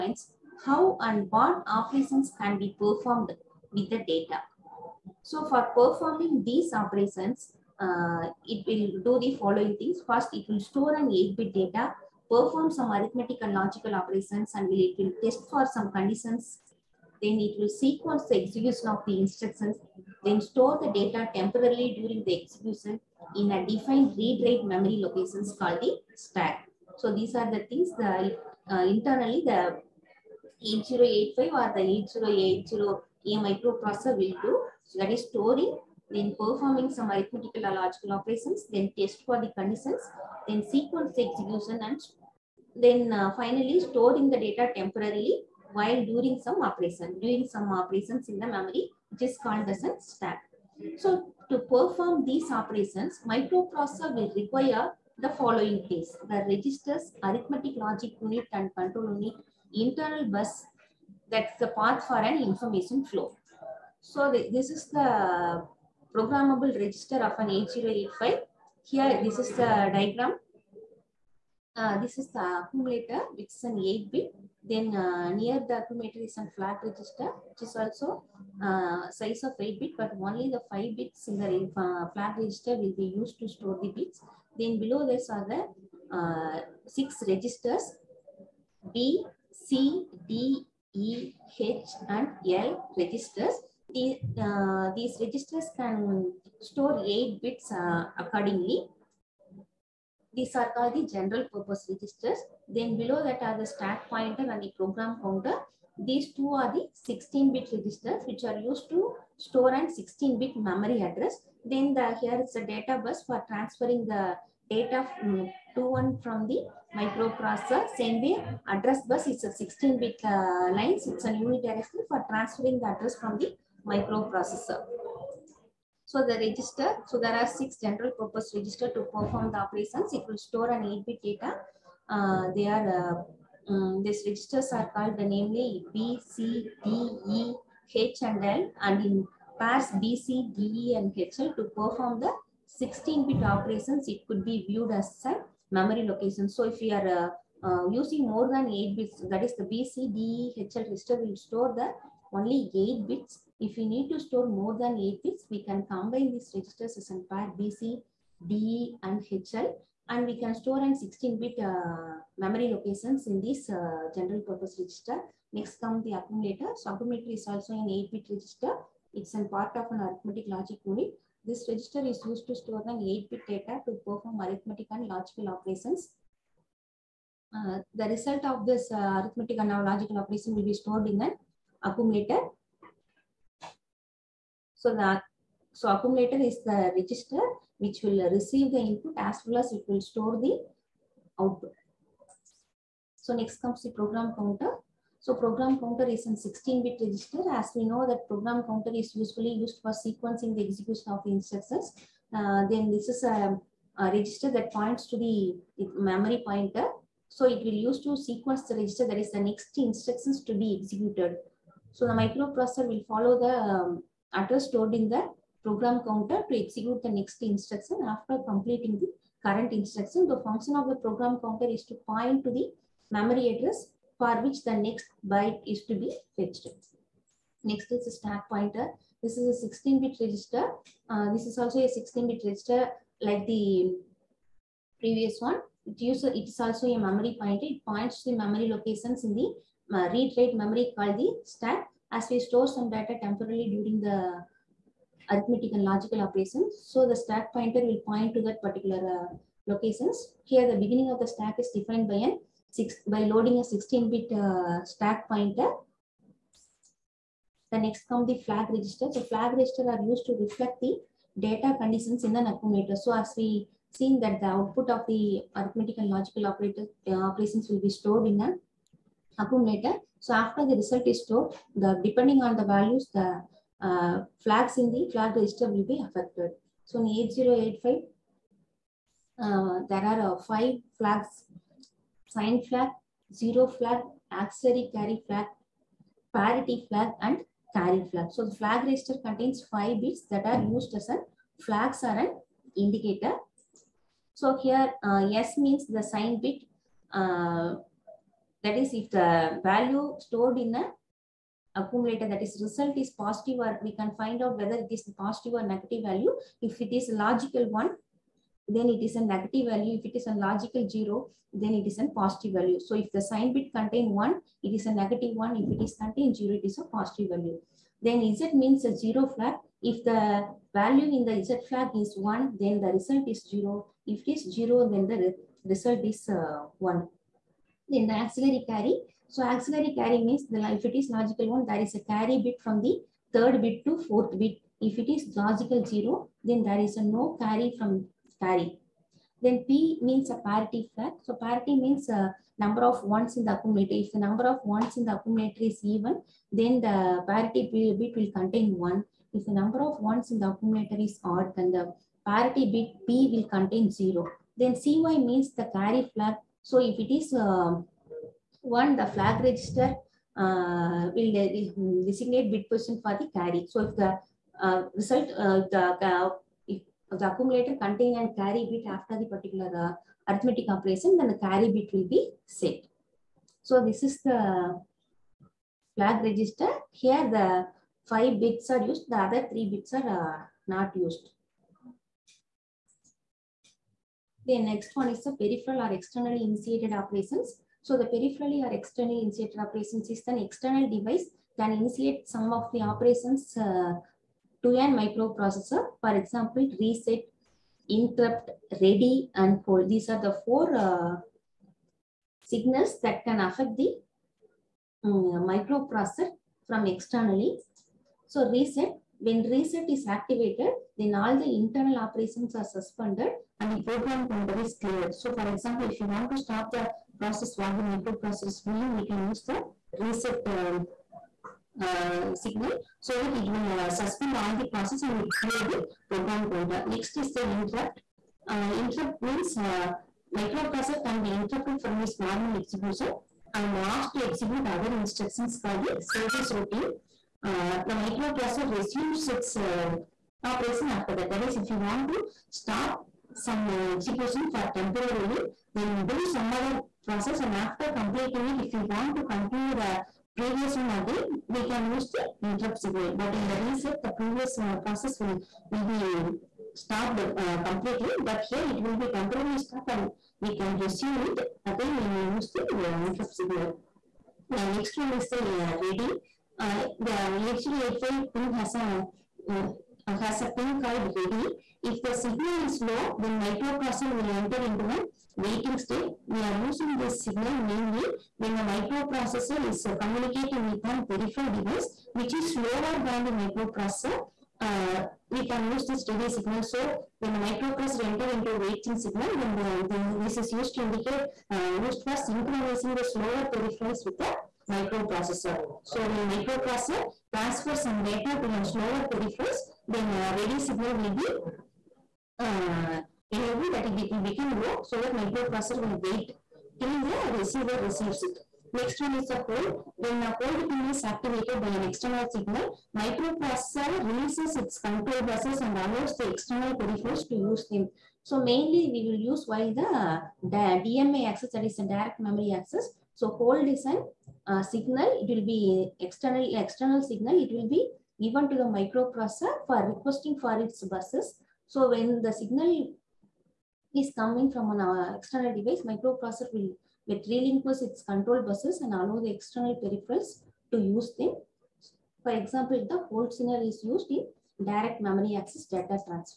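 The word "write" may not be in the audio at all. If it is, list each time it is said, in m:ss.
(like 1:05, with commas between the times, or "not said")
0:24, 4:00.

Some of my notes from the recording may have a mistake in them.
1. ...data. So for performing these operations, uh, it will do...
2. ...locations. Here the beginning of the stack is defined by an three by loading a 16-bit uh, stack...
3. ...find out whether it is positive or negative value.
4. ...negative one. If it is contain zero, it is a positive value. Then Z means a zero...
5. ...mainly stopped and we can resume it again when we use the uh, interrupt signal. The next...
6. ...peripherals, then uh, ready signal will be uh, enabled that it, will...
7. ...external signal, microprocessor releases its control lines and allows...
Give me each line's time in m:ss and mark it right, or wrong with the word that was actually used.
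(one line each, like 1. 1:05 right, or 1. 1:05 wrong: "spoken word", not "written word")
1. 0:03 right
2. 4:09 wrong: "six", not "three"
3. 5:04 right
4. 5:14 right
5. 7:39 wrong: "temporarily", not "mainly"
6. 8:19 right
7. 8:31 wrong: "buses", not "lines".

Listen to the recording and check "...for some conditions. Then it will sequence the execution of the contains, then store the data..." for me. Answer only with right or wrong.
wrong.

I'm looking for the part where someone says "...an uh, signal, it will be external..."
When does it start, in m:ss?
8:43.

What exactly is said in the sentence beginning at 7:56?
We are using this signal mainly when the microprocessor is communicating with an peripheral device, which is slower than the microprocessor.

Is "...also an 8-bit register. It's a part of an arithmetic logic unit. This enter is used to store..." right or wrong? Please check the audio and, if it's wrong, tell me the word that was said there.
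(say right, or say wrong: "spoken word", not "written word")
wrong: "register", not "enter".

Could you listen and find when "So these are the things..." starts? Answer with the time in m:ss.
0:26.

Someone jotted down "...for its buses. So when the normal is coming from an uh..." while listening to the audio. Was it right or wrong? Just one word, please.
wrong.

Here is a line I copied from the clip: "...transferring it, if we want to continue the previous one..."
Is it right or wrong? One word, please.
wrong.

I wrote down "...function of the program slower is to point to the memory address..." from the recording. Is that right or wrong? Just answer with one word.
wrong.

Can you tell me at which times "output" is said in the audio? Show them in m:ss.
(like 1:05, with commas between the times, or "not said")
3:11, 4:24.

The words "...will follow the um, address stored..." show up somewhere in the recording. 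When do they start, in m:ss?
3:32.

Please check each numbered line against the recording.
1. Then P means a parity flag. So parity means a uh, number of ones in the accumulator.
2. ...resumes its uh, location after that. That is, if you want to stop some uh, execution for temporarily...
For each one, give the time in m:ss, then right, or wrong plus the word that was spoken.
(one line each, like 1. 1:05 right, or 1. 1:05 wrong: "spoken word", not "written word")
1. 5:39 right
2. 7:18 wrong: "operation", not "location".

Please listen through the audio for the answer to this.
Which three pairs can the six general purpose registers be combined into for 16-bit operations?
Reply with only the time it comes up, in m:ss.
2:37.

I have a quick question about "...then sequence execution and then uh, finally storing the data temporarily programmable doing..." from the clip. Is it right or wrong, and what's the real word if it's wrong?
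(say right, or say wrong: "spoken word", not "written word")
wrong: "while", not "programmable".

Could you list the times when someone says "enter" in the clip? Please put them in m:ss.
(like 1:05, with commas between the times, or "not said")
7:54, 8:08.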